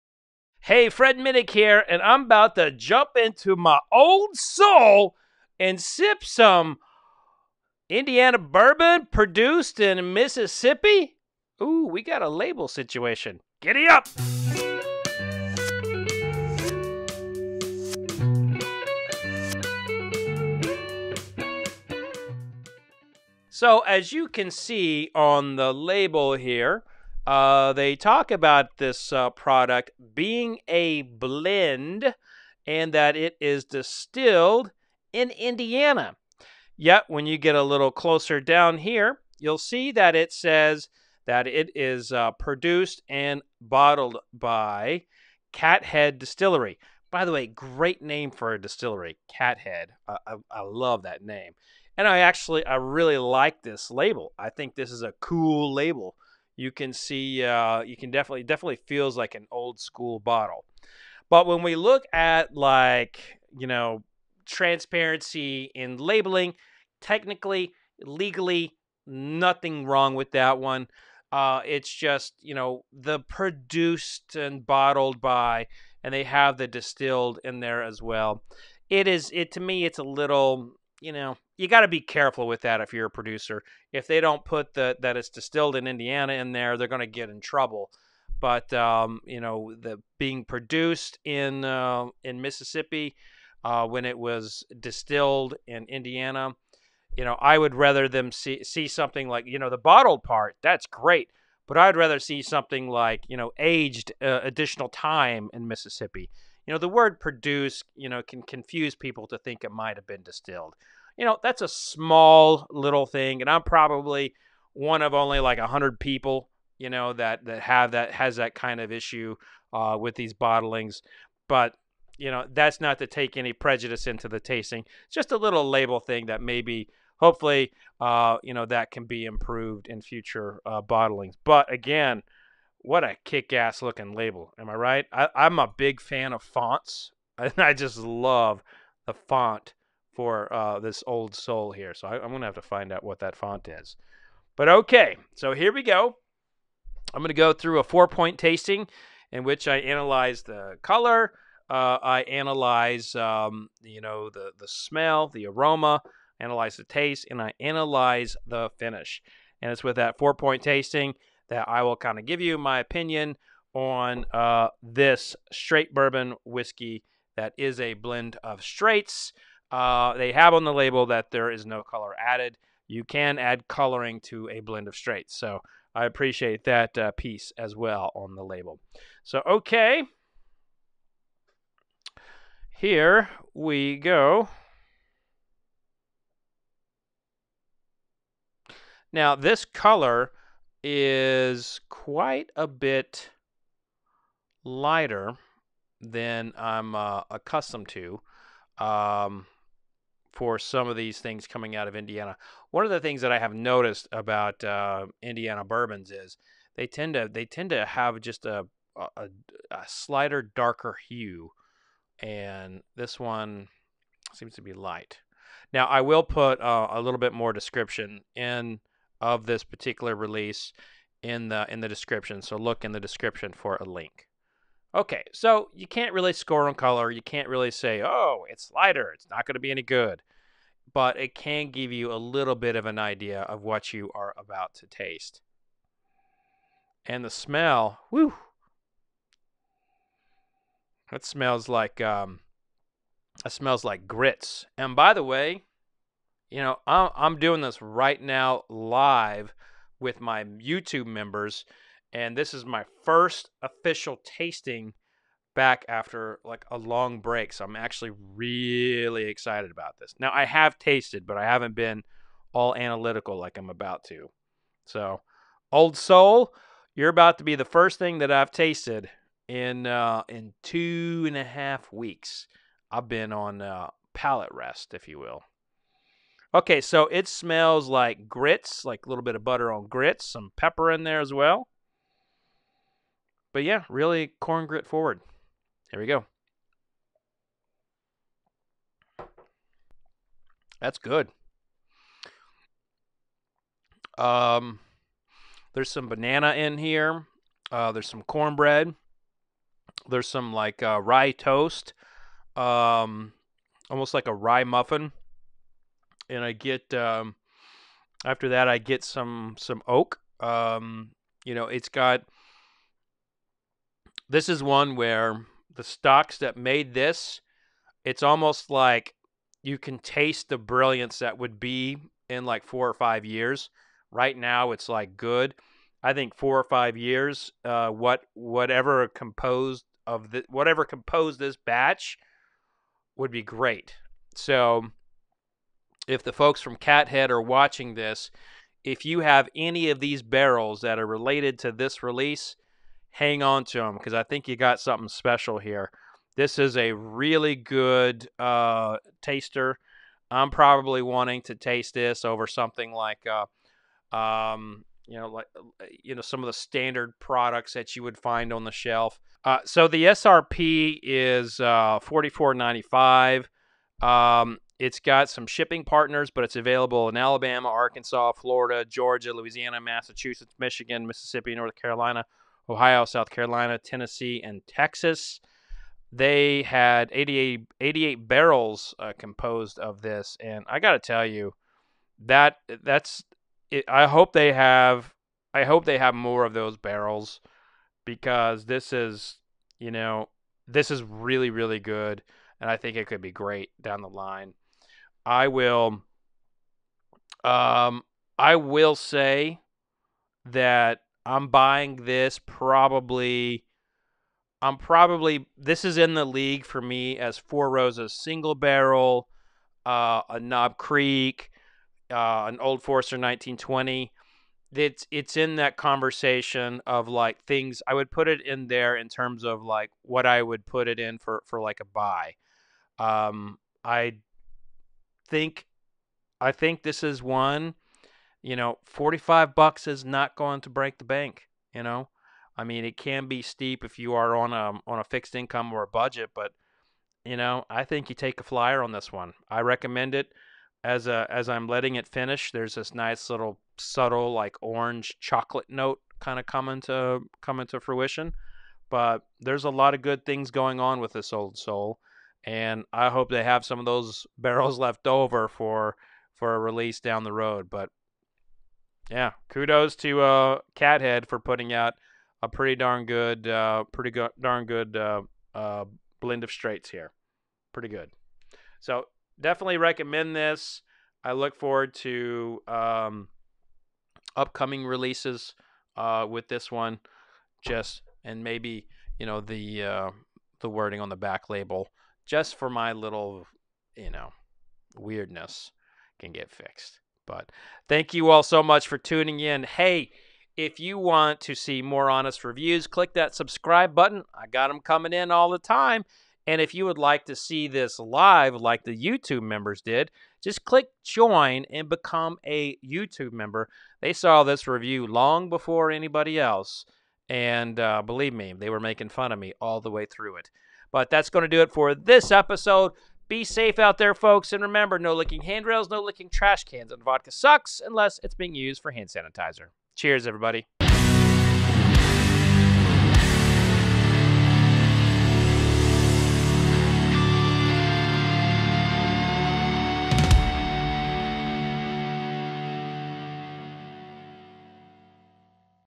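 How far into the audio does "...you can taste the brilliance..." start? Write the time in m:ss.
5:19.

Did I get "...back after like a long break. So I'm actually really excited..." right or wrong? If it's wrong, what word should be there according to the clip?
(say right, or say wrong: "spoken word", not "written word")
right.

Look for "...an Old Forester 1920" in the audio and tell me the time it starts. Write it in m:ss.
6:52.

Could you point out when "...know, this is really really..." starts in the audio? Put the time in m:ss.
6:29.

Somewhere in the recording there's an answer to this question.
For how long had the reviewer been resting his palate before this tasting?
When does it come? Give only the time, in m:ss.
4:30.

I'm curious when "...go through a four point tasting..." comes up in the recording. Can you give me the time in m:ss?
2:27.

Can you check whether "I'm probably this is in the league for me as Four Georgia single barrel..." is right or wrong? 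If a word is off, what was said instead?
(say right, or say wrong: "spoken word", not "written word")
wrong: "Roses", not "Georgia".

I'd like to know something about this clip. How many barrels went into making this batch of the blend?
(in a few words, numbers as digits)
88.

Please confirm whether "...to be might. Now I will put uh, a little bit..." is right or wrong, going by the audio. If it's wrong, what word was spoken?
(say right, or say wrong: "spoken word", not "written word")
wrong: "light", not "might".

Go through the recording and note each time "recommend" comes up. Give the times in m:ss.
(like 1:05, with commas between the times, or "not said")
7:19, 7:49.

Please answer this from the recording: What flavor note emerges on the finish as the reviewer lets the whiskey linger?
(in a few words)
Orange chocolate.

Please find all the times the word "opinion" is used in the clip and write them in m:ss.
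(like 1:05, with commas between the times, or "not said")
2:42.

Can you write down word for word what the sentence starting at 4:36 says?
Okay, so it smells like grits, like a little bit of butter on grits, some pepper in there as well.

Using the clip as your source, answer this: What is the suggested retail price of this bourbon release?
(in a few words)
$44.95.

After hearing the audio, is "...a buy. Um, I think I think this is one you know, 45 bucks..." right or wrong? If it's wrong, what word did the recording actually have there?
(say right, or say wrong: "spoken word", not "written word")
right.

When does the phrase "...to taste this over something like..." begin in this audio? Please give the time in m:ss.
5:51.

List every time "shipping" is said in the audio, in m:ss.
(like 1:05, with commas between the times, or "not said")
6:05.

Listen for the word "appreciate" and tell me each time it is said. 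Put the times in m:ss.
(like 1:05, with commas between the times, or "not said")
2:56.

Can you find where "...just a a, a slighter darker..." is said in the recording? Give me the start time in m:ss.
3:28.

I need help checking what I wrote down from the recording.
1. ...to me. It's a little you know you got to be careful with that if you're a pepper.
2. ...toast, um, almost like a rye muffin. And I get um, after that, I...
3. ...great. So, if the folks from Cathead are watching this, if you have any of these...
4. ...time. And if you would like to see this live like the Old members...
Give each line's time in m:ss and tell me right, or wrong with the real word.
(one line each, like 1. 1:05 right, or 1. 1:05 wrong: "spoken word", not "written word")
1. 1:19 wrong: "producer", not "pepper"
2. 5:01 right
3. 5:33 right
4. 8:15 wrong: "YouTube", not "Old".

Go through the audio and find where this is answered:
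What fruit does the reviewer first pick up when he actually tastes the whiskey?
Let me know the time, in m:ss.
4:56.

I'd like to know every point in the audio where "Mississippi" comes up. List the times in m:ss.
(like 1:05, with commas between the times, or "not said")
0:10, 1:32, 1:45, 6:11.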